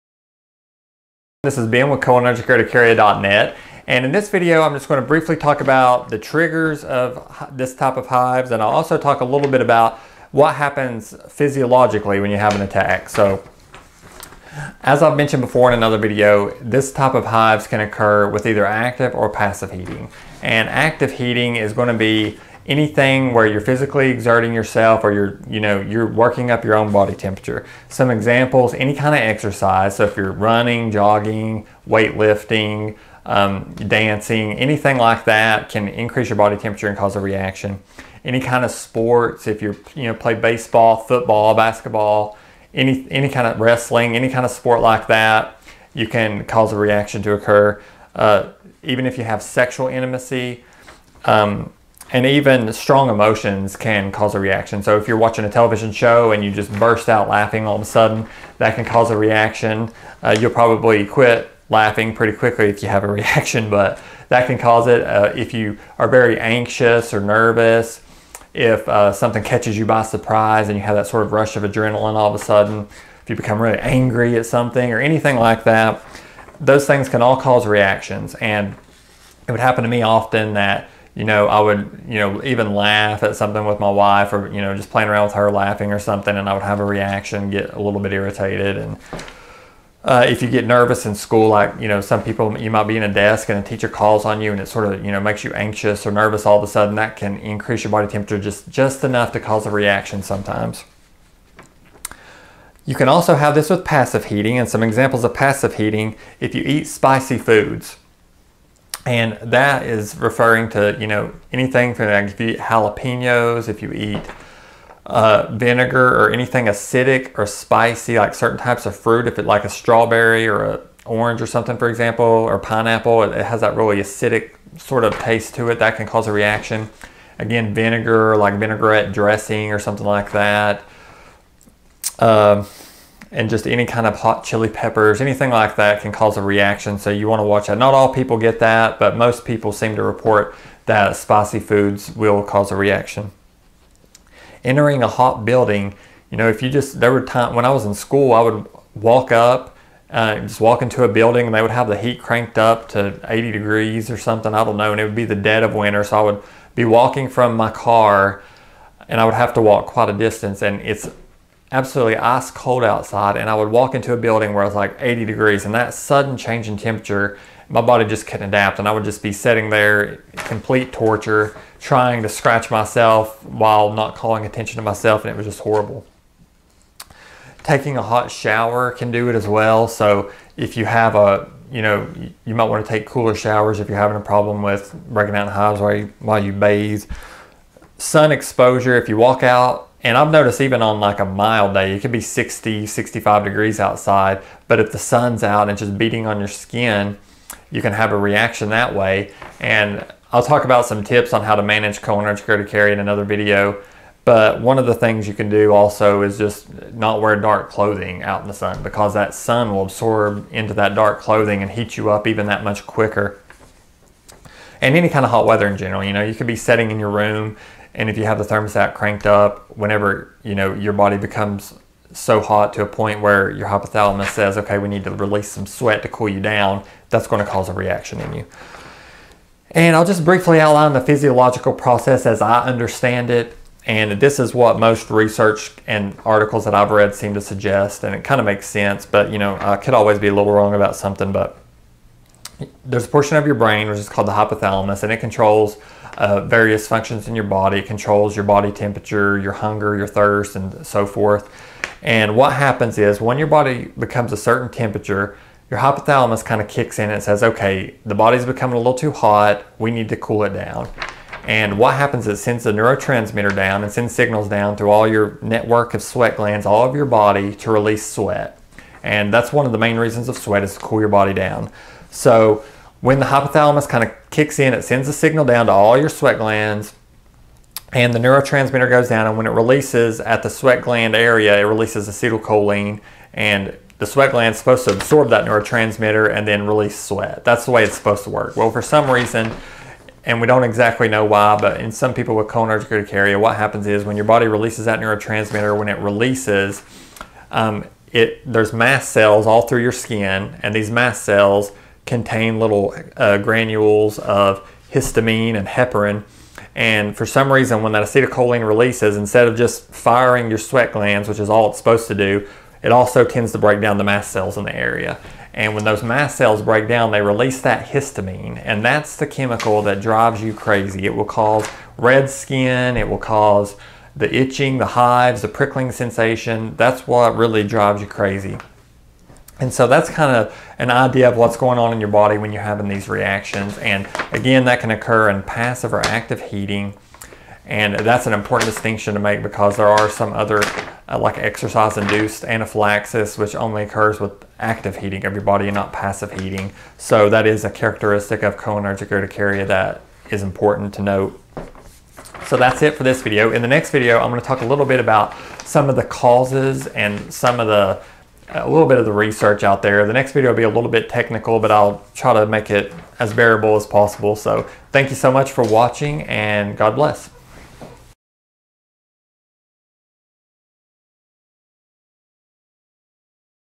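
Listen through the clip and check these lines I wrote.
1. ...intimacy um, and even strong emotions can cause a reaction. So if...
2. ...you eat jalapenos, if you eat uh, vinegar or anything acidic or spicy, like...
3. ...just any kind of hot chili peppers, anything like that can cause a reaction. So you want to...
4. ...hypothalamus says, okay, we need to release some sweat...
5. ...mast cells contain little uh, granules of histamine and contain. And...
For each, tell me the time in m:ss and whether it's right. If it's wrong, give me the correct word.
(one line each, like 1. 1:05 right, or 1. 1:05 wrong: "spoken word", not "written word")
1. 0:49 right
2. 1:52 right
3. 2:13 right
4. 3:43 right
5. 5:00 wrong: "heparin", not "contain".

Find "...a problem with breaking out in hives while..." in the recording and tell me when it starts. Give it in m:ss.
3:04.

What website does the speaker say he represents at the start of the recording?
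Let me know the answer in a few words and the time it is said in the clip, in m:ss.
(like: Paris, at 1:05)
CholinergicUrticaria.net, at 0:02.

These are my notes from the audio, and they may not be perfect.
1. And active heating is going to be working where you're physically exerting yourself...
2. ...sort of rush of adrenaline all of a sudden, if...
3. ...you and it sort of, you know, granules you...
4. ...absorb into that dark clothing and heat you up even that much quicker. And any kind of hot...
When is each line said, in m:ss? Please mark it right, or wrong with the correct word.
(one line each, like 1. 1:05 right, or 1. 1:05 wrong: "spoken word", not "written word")
1. 0:20 wrong: "anything", not "working"
2. 1:11 right
3. 1:34 wrong: "makes", not "granules"
4. 3:29 right.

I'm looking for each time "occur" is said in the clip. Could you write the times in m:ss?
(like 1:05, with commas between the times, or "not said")
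0:17, 0:47, 5:34, 5:43.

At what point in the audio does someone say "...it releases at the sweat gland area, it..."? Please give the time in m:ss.
4:39.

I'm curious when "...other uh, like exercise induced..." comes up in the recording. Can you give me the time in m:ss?
5:40.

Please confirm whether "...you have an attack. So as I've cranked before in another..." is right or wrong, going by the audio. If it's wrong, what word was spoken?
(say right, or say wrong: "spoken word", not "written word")
wrong: "mentioned", not "cranked".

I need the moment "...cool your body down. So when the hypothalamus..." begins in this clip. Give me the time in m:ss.
4:30.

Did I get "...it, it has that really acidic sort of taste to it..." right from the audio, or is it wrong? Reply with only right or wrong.
right.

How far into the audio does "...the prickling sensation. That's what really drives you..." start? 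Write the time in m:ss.
5:25.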